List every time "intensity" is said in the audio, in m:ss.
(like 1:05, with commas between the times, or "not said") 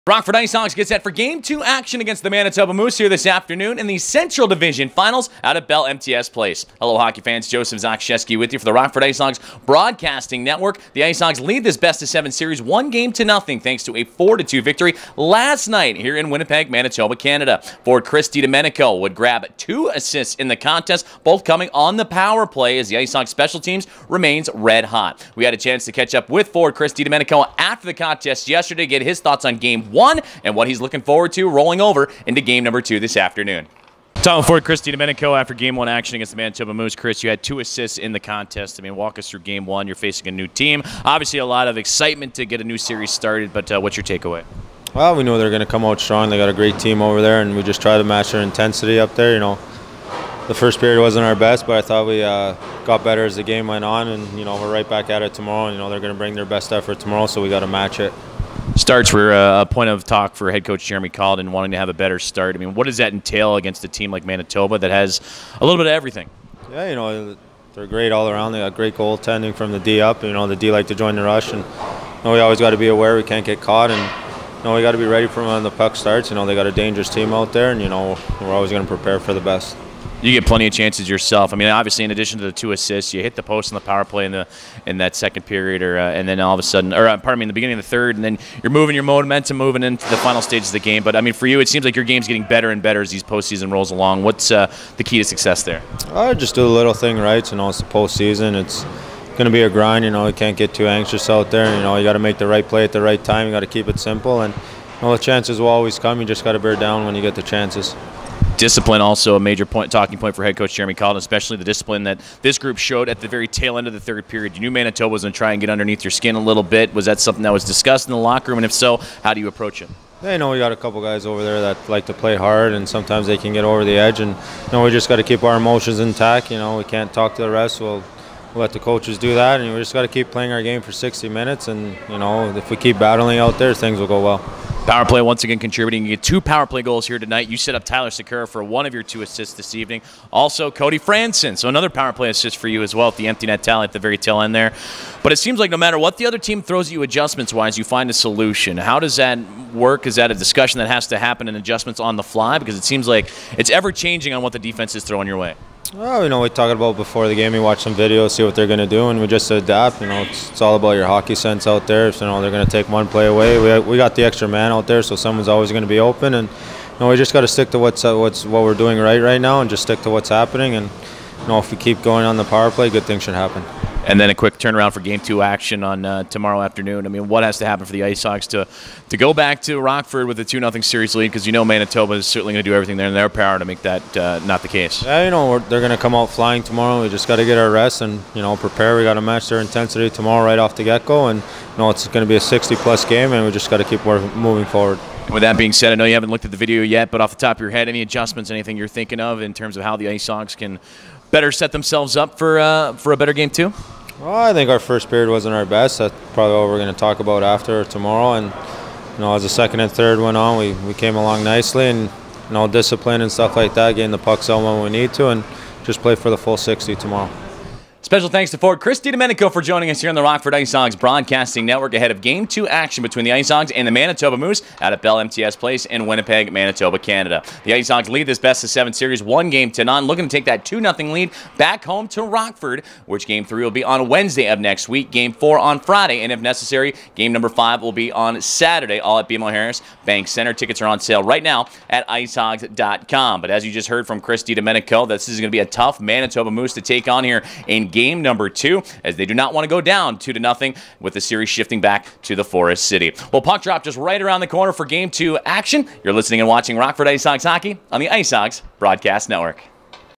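0:48, 3:09.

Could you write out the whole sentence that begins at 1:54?
You knew Manitoba was going to try and get underneath your skin a little bit.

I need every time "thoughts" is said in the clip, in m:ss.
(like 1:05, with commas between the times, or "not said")
0:29, 0:51.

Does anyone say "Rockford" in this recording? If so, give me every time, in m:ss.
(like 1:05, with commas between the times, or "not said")
0:00, 0:08, 2:59, 3:40, 3:52, 4:16.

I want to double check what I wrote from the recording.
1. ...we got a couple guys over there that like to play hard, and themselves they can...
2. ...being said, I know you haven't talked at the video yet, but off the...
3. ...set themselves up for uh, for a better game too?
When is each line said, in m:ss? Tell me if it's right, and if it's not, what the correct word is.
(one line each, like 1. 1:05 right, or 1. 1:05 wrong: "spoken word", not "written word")
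1. 2:00 wrong: "sometimes", not "themselves"
2. 3:15 wrong: "looked", not "talked"
3. 3:21 right.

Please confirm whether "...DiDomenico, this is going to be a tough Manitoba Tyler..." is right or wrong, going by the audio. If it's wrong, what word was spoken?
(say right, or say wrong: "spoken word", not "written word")
wrong: "Moose", not "Tyler".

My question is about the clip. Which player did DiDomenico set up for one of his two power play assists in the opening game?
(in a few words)
Tyler Sikura.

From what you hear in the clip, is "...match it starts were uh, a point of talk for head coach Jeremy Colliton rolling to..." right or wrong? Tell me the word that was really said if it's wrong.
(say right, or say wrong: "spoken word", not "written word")
wrong: "wanting", not "rolling".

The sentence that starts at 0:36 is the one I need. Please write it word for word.
Chris, you had two assists in the contest.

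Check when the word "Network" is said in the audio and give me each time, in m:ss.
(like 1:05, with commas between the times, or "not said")
0:10, 3:41, 4:19.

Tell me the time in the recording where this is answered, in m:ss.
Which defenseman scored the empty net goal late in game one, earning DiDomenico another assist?
2:20.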